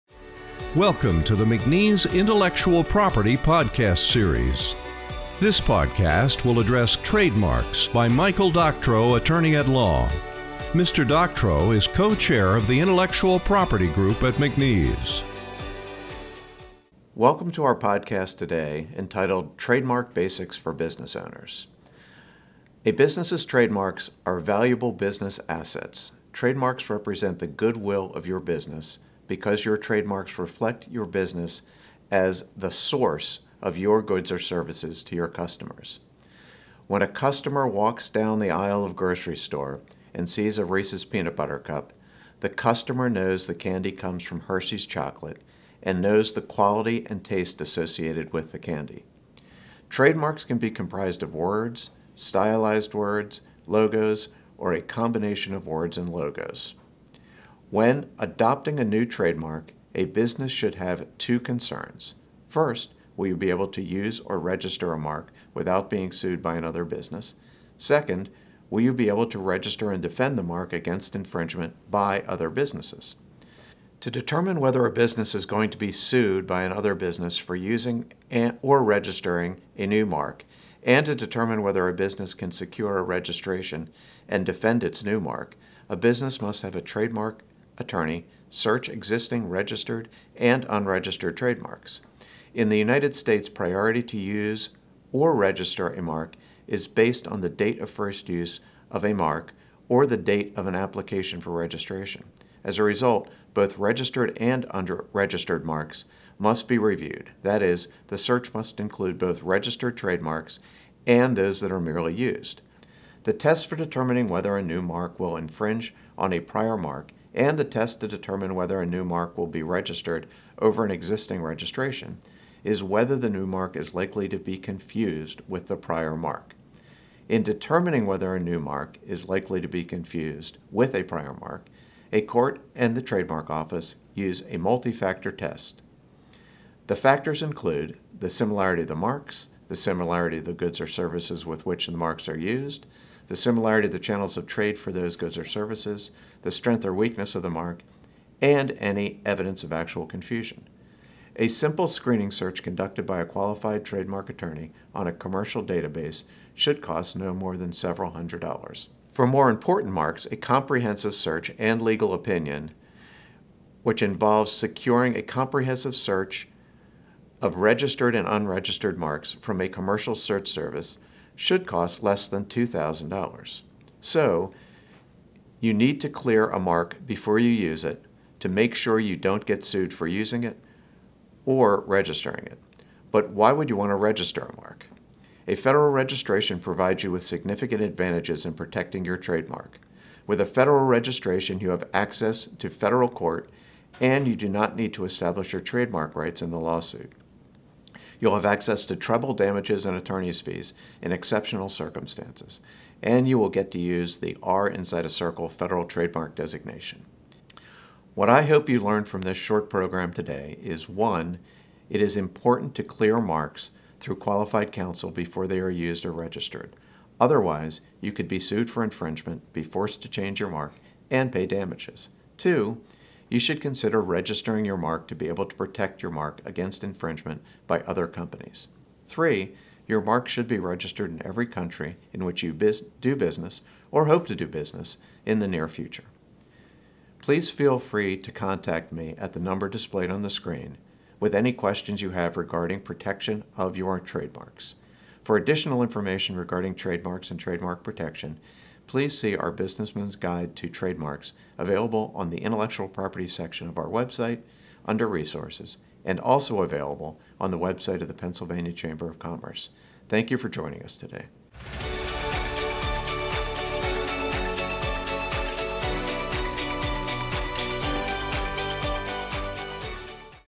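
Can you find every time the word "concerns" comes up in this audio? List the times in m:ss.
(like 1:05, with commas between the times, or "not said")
1:01.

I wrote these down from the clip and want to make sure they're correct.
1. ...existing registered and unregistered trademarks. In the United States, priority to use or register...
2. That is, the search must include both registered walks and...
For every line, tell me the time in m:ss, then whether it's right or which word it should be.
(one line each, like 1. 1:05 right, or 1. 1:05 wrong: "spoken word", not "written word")
1. 1:28 right
2. 1:47 wrong: "trademarks", not "walks".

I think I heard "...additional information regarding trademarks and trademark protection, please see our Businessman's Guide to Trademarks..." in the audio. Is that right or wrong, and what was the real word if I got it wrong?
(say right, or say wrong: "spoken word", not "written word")
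right.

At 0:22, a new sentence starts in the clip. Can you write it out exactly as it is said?
A business's trademarks are valuable business assets.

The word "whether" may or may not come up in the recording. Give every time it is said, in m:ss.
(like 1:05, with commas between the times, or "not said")
1:14, 1:21, 1:54, 1:58, 2:02, 2:08.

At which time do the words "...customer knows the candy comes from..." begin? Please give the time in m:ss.
0:42.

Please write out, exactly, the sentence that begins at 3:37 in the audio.
Otherwise, you could be sued for infringement, be forced to change your mark, and pay damages.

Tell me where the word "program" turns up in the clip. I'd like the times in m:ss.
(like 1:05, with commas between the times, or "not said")
3:29.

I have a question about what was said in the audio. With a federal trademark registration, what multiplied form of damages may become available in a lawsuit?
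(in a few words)
Treble damages.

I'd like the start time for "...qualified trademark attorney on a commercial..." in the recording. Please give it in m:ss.
2:33.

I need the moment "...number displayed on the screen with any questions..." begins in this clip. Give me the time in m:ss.
3:59.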